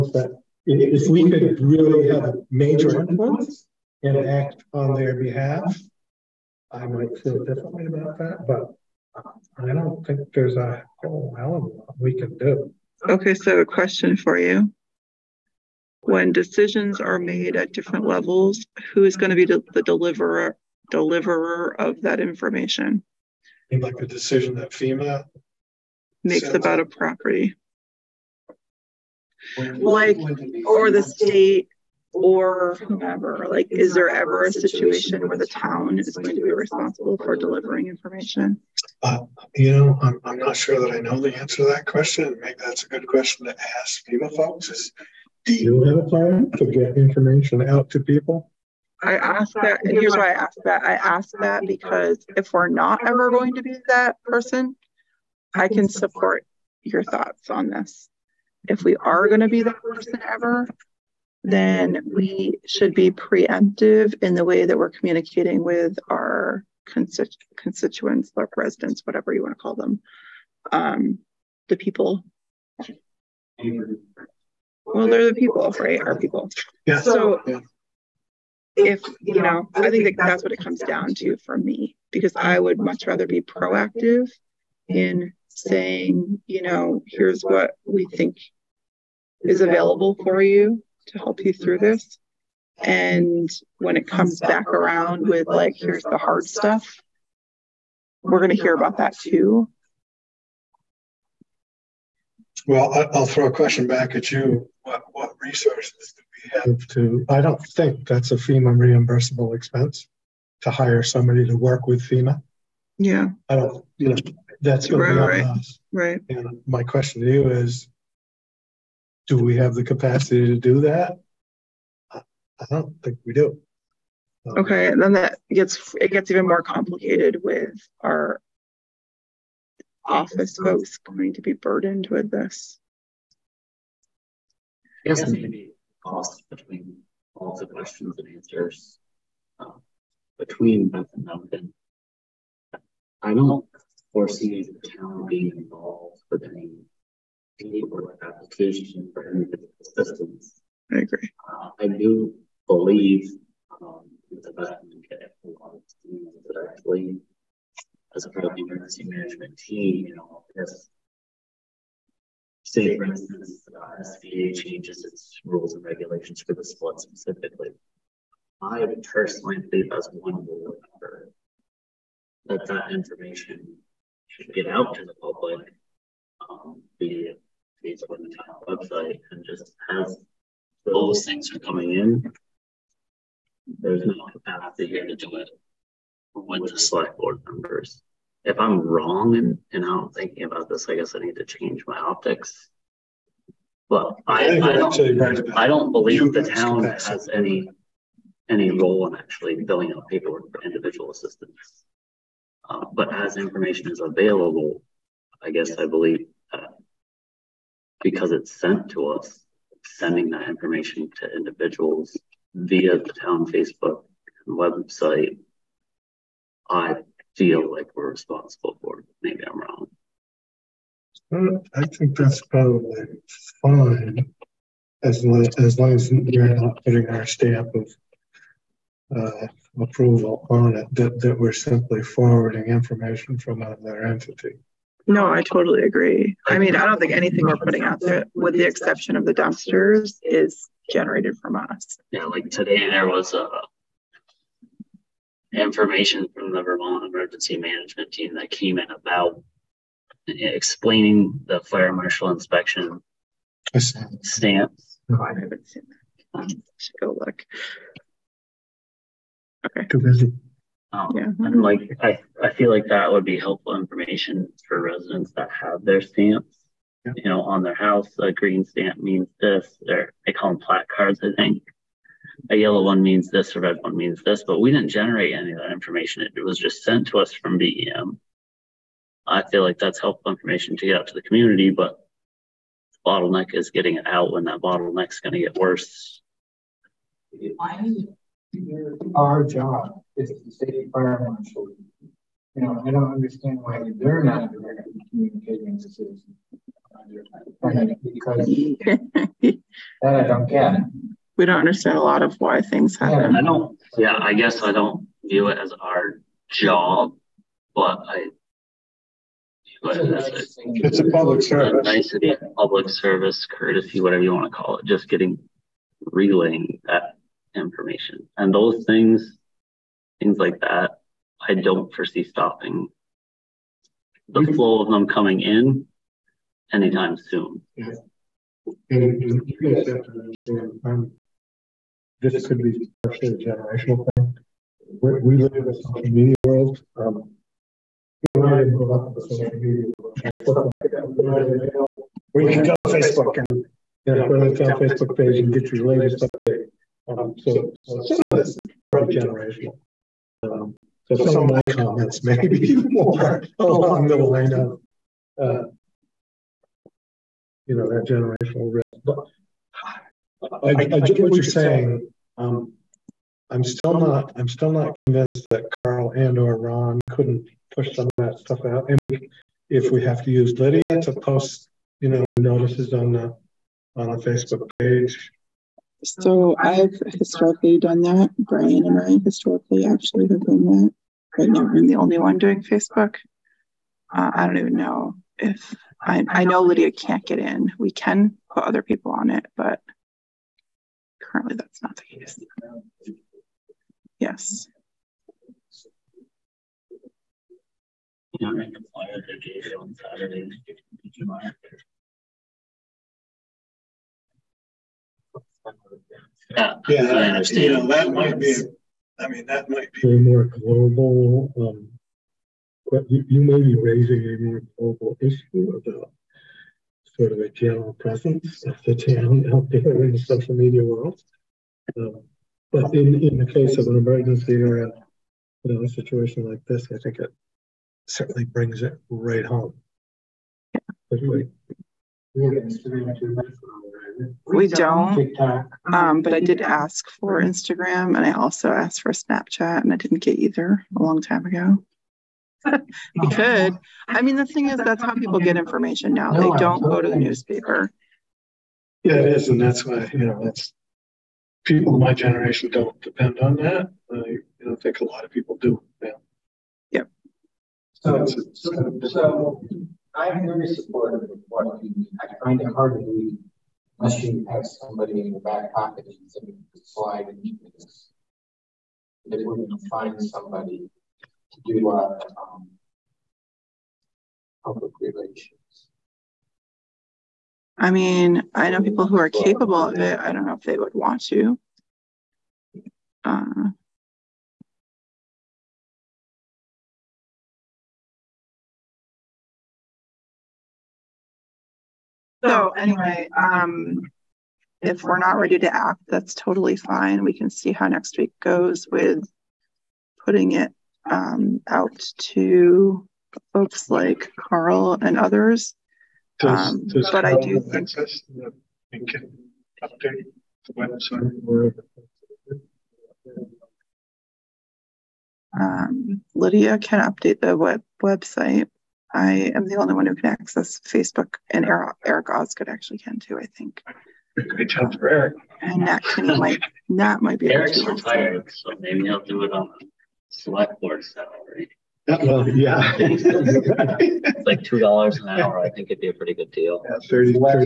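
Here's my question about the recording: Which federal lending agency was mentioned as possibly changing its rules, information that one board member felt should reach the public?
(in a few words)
SBA.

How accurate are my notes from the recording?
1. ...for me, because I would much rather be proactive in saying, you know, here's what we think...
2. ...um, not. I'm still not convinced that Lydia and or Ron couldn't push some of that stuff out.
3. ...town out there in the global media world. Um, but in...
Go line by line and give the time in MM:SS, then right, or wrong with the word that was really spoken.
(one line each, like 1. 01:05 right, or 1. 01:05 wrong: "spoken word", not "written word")
1. 01:21 right
2. 06:03 wrong: "Carl", not "Lydia"
3. 06:58 wrong: "social", not "global".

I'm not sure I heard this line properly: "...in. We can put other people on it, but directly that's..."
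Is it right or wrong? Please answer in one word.
wrong.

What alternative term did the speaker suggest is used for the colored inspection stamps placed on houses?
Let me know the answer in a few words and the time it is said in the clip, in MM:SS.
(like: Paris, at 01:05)
placards, at 04:30.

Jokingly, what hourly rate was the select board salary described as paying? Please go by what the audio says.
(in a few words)
$2 an hour.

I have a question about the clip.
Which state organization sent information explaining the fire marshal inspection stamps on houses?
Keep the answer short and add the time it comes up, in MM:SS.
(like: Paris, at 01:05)
Vermont Emergency Management, at 04:06.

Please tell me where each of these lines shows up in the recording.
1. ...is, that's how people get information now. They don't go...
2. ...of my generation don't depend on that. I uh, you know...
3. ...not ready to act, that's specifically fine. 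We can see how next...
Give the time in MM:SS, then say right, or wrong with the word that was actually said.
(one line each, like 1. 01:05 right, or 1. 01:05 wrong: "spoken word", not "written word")
1. 07:24 right
2. 07:31 right
3. 08:15 wrong: "totally", not "specifically".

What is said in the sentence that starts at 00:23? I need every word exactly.
Like the decision that FEMA makes about a property, like or the state or whomever?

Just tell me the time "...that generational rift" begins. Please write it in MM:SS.
05:57.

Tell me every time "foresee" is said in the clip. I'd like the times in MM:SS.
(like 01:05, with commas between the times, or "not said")
02:24, 05:21.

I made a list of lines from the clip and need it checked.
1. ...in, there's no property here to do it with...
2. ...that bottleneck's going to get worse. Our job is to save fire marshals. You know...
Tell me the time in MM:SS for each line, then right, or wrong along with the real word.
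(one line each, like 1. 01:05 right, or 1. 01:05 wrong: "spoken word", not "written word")
1. 03:01 wrong: "capacity", not "property"
2. 04:44 right.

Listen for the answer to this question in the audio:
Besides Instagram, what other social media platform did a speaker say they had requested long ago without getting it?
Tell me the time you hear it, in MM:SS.
07:19.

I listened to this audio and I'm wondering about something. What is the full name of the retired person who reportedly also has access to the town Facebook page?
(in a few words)
Eric Osgood.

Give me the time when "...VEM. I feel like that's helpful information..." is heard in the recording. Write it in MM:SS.
04:37.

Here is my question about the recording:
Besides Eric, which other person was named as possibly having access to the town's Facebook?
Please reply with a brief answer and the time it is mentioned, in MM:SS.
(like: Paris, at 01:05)
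Nat Kinney, at 08:45.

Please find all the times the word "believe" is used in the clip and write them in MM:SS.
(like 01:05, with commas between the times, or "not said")
02:32, 02:49, 03:15, 03:25, 07:43.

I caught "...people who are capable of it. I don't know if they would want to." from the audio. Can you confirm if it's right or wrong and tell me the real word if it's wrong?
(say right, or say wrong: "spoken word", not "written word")
right.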